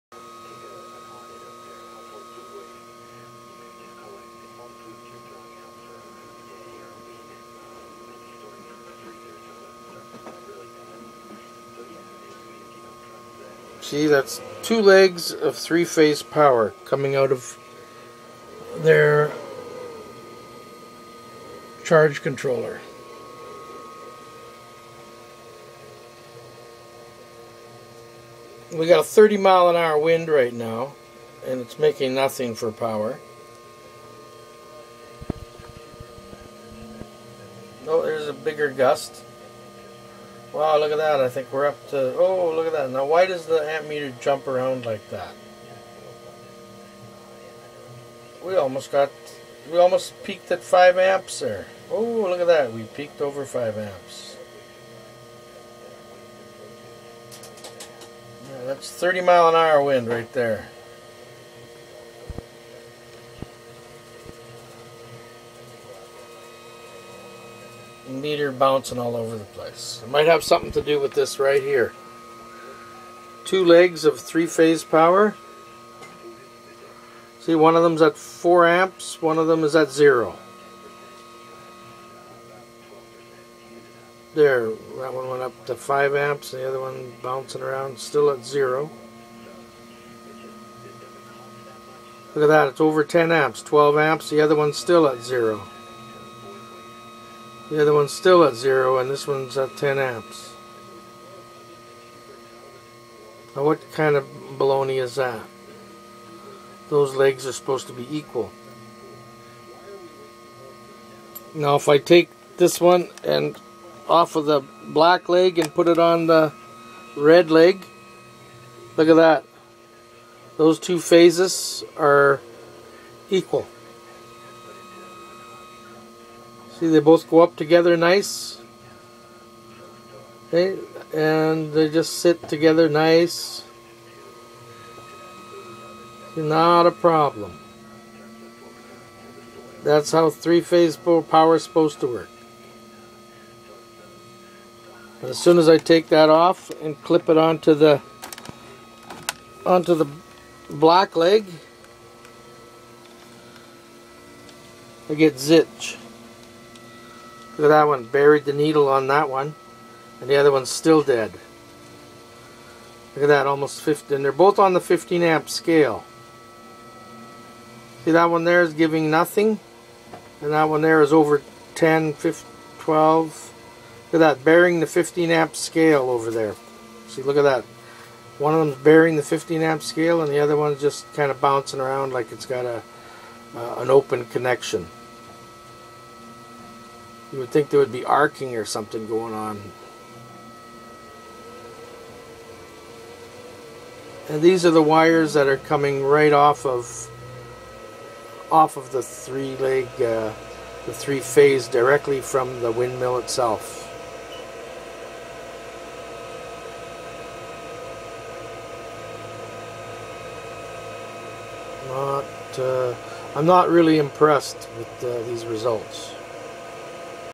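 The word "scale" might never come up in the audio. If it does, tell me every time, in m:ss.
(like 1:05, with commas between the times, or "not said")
2:45, 2:55, 2:59.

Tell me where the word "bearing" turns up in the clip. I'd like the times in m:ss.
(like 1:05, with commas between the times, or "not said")
2:54, 2:58.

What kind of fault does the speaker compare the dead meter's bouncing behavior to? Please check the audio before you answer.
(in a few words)
open connection.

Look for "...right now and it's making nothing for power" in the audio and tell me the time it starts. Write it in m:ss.
0:30.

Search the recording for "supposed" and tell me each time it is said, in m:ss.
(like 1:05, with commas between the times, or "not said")
1:47, 2:21.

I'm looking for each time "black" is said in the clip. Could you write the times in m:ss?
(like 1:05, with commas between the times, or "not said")
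1:54, 2:30.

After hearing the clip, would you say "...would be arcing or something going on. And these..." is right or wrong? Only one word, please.
right.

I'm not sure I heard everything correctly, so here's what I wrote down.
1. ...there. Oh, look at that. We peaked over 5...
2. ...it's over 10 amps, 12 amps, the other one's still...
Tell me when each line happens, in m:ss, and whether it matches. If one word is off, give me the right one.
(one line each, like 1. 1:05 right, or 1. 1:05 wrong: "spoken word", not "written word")
1. 0:51 right
2. 1:32 right.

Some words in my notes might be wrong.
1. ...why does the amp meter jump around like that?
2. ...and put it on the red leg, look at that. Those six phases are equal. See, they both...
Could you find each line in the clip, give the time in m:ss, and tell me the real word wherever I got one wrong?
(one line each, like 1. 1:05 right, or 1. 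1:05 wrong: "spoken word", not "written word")
1. 0:43 right
2. 1:55 wrong: "two", not "six".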